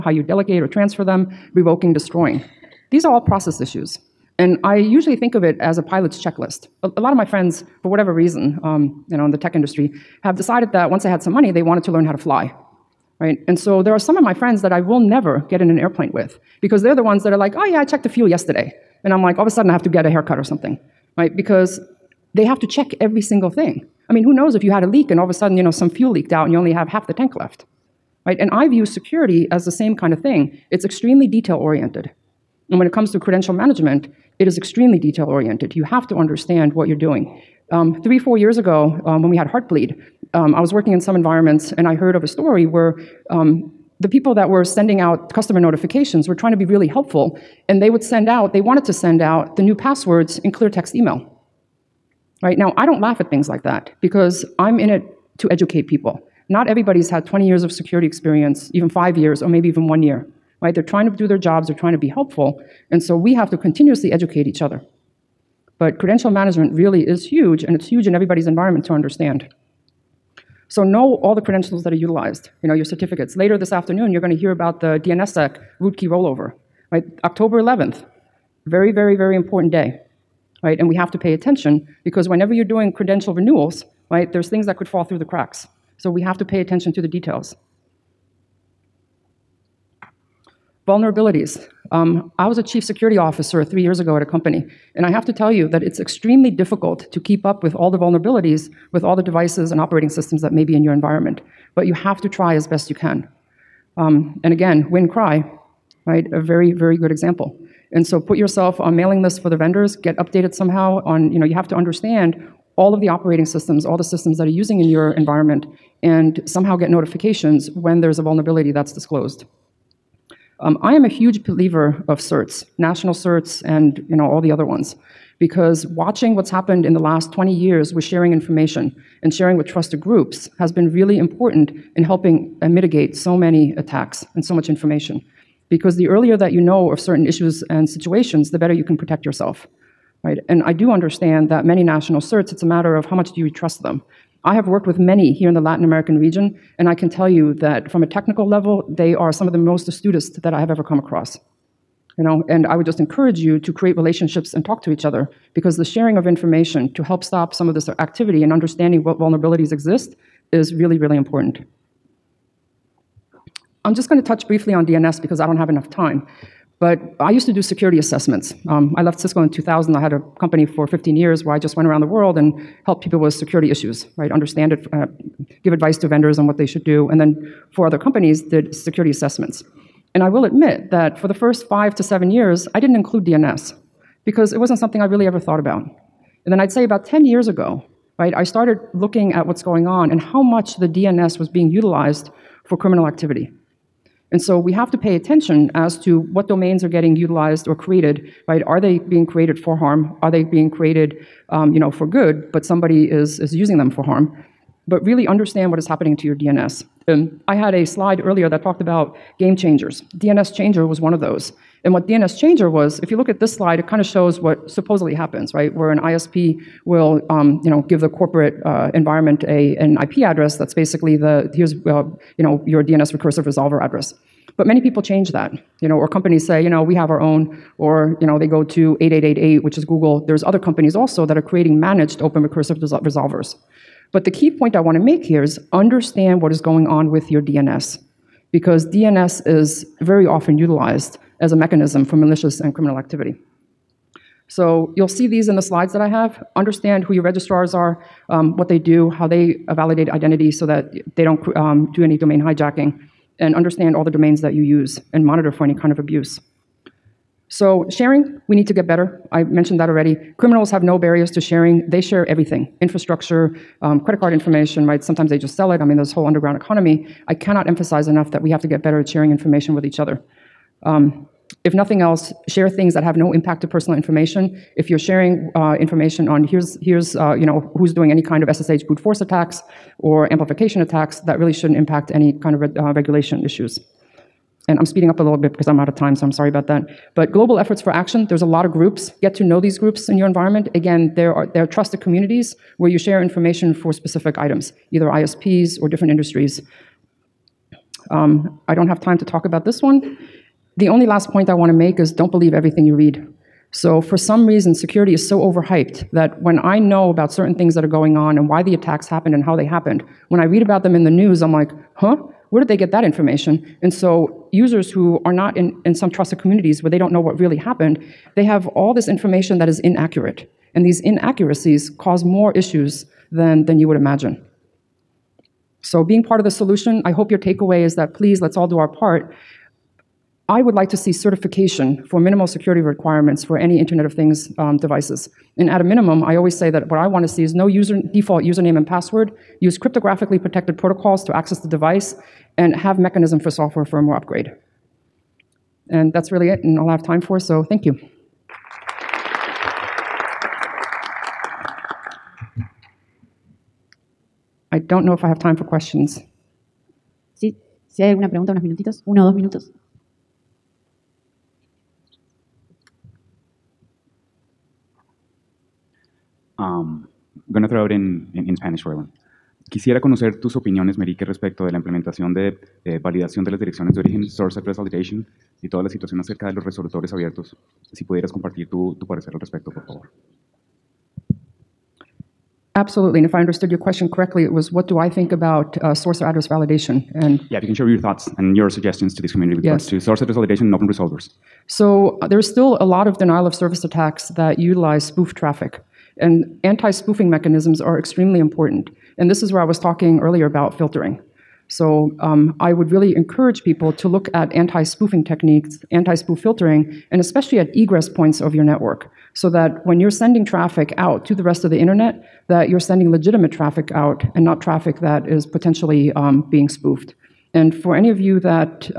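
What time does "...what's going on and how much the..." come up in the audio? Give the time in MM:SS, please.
03:09.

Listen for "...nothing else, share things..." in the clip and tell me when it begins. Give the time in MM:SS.
04:31.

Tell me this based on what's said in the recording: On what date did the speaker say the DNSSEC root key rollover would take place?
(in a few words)
October 11th.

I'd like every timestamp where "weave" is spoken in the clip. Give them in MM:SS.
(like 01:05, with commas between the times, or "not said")
not said.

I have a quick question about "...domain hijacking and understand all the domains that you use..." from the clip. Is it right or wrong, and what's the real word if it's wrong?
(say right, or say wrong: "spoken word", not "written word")
right.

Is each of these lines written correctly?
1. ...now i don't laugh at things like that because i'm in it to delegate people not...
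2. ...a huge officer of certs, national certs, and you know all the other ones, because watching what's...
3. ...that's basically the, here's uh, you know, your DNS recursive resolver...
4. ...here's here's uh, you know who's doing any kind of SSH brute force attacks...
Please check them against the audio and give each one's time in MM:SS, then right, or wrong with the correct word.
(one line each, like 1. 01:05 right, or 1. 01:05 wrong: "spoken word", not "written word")
1. 00:52 wrong: "educate", not "delegate"
2. 02:01 wrong: "believer", not "officer"
3. 03:40 right
4. 04:36 right.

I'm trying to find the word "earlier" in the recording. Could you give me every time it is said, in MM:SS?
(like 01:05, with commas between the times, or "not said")
02:16, 03:28, 06:40.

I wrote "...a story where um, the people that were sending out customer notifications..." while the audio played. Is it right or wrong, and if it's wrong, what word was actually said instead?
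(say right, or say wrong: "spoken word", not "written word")
right.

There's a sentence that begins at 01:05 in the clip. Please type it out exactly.
But credential management really is huge, and it's huge in everybody's environment to understand.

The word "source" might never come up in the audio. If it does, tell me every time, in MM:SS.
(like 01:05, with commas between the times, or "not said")
06:14, 06:25, 06:29.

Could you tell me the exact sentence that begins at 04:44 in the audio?
And I'm speeding up a little bit because I'm out of time, so I'm sorry about that.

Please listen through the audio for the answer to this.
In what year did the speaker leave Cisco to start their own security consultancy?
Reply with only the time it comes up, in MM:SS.
02:49.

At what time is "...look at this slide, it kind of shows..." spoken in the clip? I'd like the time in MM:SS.
03:33.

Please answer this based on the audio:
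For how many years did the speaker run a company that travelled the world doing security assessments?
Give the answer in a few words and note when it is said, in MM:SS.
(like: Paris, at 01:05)
15 years, at 02:50.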